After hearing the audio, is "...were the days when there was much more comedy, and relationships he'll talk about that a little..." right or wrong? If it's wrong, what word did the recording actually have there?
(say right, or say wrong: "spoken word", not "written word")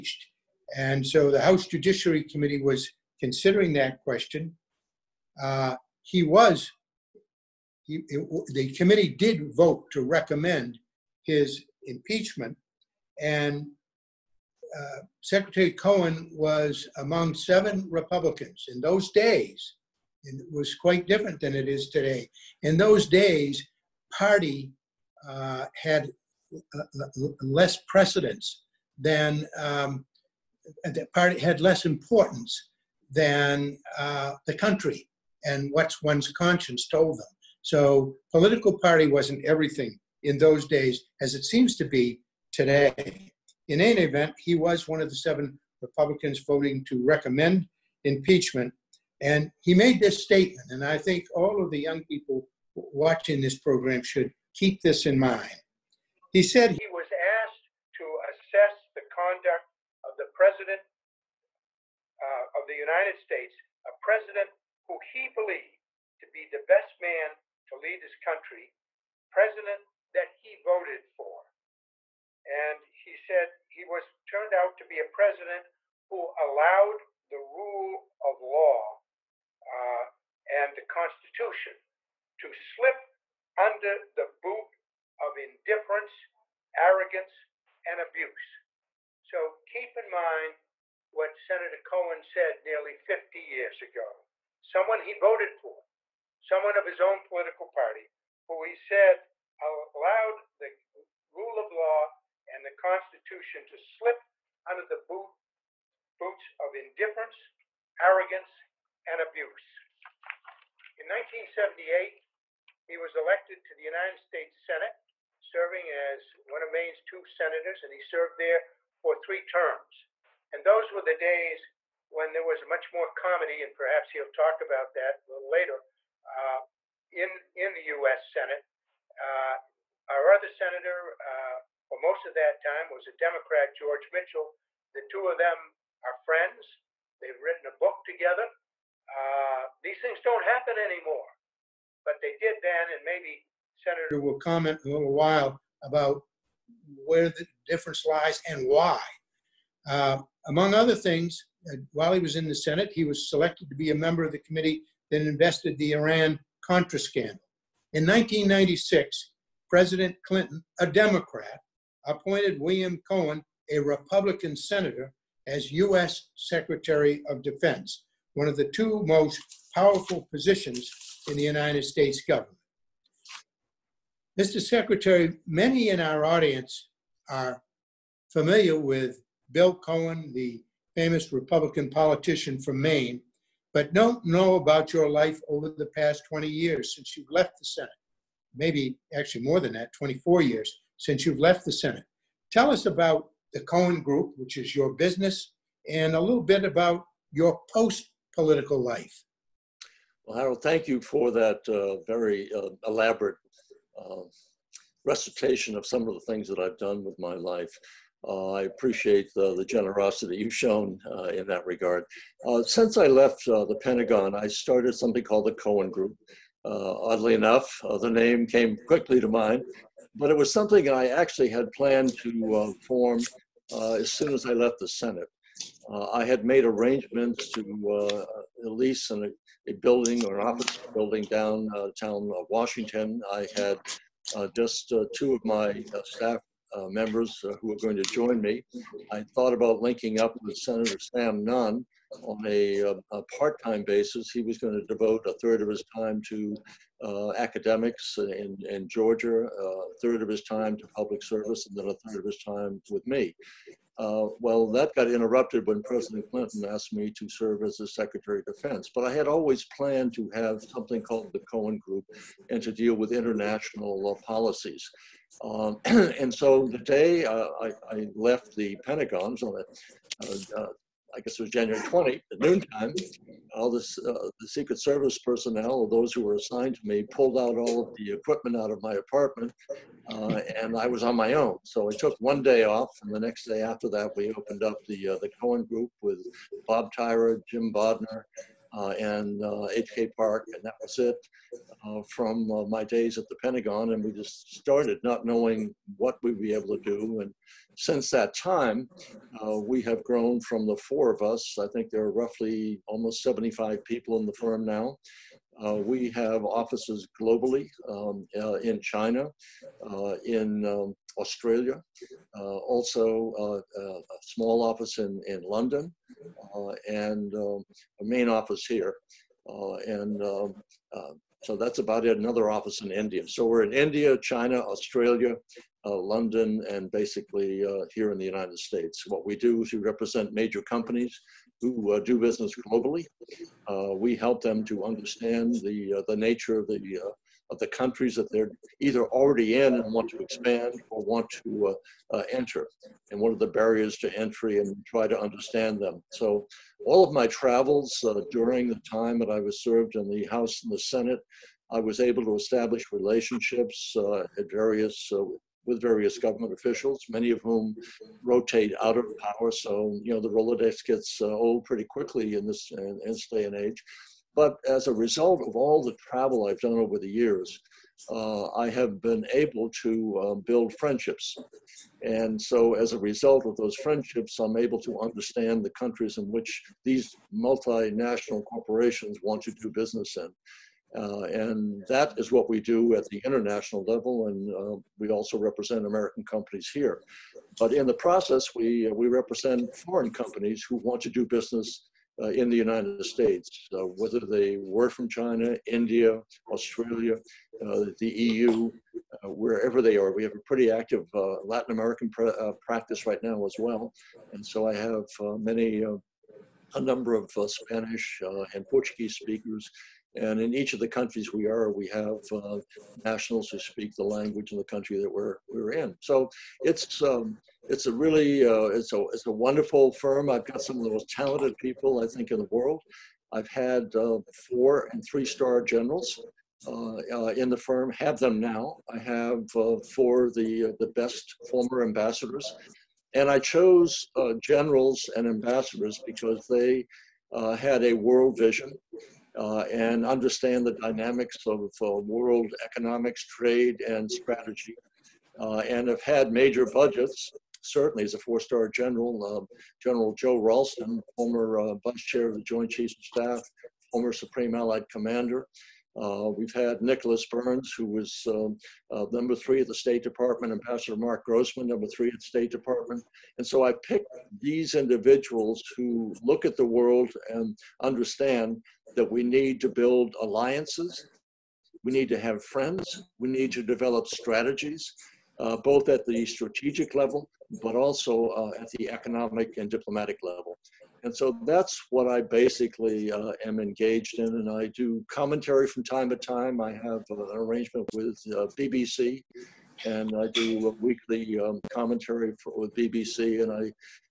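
wrong: "perhaps", not "relationships".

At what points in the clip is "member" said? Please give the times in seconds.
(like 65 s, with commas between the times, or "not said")
153 s, 236 s.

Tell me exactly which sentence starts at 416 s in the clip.
So it's um, it's a really uh, it's a it's a wonderful firm.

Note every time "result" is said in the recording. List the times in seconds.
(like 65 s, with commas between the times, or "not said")
364 s, 372 s.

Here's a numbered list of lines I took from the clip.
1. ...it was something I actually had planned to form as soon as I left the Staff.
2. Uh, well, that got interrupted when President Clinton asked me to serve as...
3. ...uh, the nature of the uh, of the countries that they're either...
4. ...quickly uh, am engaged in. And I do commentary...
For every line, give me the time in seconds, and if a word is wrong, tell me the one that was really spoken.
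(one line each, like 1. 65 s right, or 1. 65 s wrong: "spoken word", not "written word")
1. 220 s wrong: "Senate", not "Staff"
2. 253 s right
3. 335 s right
4. 482 s wrong: "basically", not "quickly".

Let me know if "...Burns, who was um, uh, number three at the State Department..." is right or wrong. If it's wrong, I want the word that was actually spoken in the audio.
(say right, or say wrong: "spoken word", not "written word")
right.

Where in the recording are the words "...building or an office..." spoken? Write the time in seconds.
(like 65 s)
229 s.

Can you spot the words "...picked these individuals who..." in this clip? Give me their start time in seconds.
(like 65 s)
463 s.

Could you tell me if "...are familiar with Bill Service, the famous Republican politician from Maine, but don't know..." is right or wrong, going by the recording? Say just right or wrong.
wrong.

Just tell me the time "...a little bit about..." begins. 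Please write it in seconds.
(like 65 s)
196 s.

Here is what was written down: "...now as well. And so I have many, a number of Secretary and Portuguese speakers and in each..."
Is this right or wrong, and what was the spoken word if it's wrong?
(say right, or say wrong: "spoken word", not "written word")
wrong: "Spanish", not "Secretary".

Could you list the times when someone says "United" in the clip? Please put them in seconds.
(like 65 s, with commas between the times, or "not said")
62 s, 113 s, 171 s, 328 s, 392 s.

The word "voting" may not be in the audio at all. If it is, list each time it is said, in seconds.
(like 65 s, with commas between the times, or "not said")
46 s.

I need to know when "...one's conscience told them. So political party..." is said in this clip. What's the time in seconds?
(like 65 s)
36 s.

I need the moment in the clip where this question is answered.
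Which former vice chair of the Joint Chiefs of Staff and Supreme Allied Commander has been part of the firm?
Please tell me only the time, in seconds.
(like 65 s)
450 s.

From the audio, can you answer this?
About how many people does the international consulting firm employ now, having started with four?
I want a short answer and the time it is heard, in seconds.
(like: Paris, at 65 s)
75, at 303 s.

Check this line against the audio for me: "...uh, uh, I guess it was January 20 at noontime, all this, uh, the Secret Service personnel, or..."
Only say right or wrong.
right.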